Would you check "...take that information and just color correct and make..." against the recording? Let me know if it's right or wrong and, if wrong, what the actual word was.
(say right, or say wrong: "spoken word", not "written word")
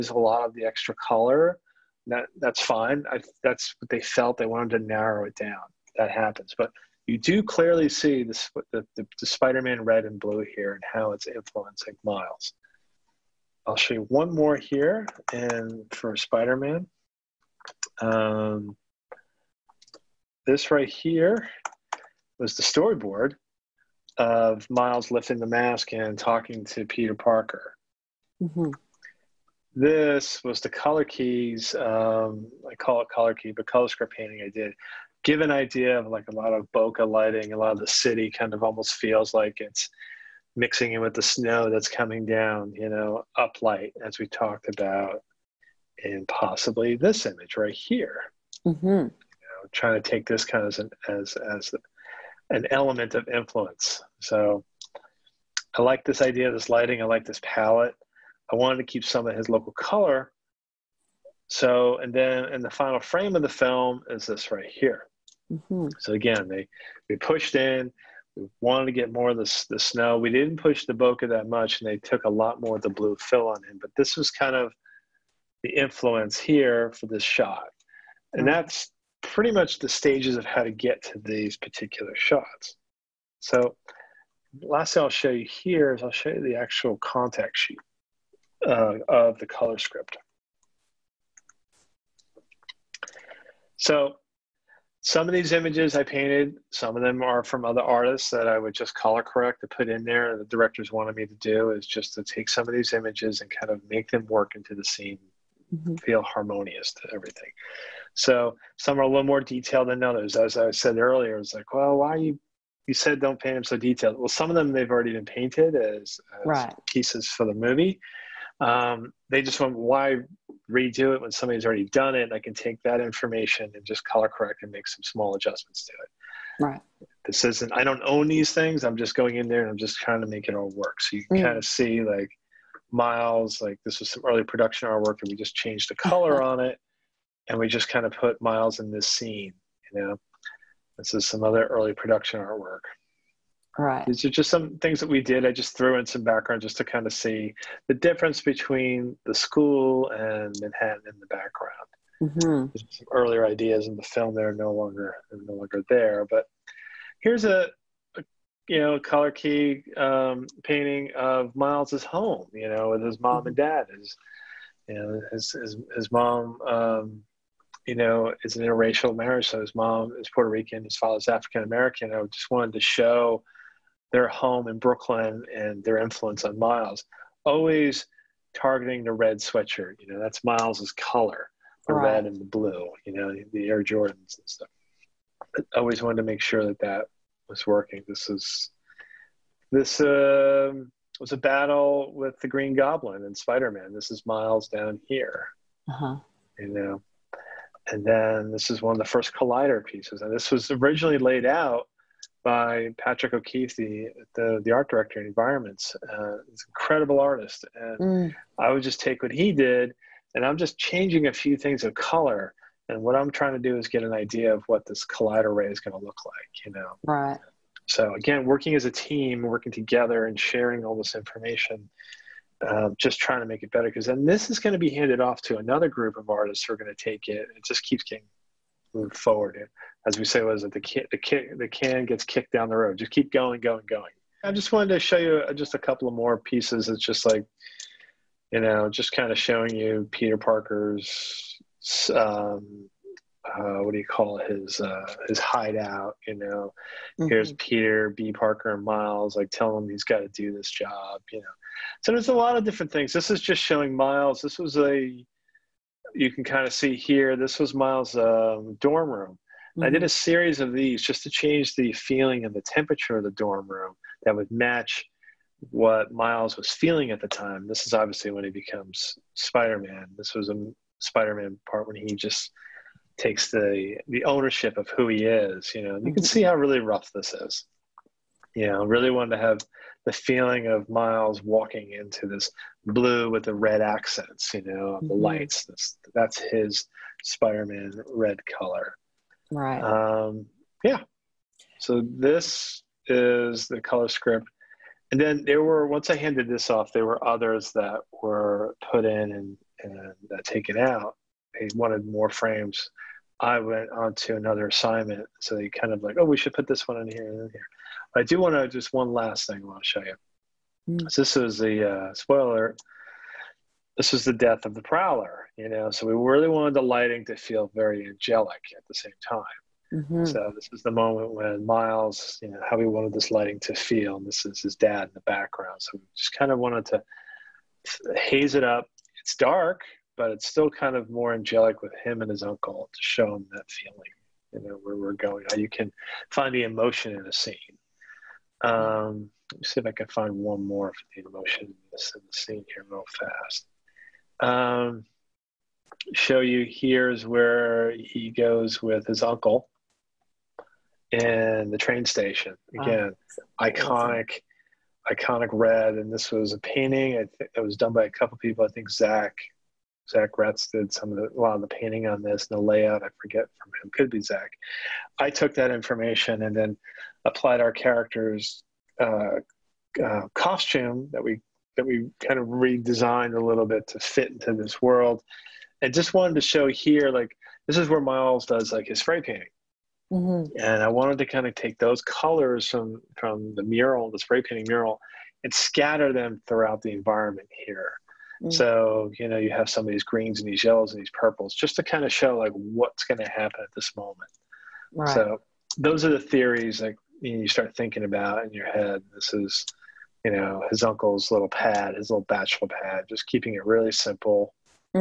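right.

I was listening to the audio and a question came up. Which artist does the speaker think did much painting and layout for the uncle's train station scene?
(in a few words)
Zach Ratz.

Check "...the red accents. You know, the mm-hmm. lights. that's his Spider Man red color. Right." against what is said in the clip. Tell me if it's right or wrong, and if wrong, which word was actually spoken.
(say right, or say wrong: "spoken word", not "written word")
right.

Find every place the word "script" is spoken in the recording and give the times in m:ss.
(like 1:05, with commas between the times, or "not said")
0:33, 1:29, 4:54.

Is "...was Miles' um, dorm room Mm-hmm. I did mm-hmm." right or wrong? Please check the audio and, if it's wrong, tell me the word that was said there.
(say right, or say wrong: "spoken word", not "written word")
right.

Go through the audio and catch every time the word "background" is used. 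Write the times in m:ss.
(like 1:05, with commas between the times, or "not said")
2:26, 2:31, 5:25.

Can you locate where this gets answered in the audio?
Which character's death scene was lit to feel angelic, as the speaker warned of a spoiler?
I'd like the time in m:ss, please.
5:14.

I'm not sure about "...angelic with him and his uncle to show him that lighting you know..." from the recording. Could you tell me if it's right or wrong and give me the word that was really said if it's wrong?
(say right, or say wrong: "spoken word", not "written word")
wrong: "feeling", not "lighting".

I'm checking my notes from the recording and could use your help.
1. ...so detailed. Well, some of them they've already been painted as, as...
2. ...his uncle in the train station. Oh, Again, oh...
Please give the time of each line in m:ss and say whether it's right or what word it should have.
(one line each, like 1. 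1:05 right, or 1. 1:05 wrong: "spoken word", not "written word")
1. 1:53 right
2. 5:49 right.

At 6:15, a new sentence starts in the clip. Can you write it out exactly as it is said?
And just wanted to show here, like, this is where Miles does like his spray painting.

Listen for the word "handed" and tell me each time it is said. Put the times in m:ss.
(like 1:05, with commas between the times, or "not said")
3:44, 4:56.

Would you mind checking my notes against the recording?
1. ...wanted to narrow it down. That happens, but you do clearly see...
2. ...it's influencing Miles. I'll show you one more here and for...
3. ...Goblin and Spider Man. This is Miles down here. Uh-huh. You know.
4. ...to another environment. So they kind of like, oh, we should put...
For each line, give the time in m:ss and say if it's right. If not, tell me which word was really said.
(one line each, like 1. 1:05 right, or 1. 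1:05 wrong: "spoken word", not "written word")
1. 0:04 right
2. 0:11 right
3. 3:12 right
4. 5:04 wrong: "assignment", not "environment".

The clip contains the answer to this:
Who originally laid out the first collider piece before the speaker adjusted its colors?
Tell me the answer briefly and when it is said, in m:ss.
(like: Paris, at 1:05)
Patrick O'Keefe, at 3:22.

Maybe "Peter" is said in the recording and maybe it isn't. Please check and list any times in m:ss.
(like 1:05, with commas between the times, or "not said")
0:26, 4:00, 4:07.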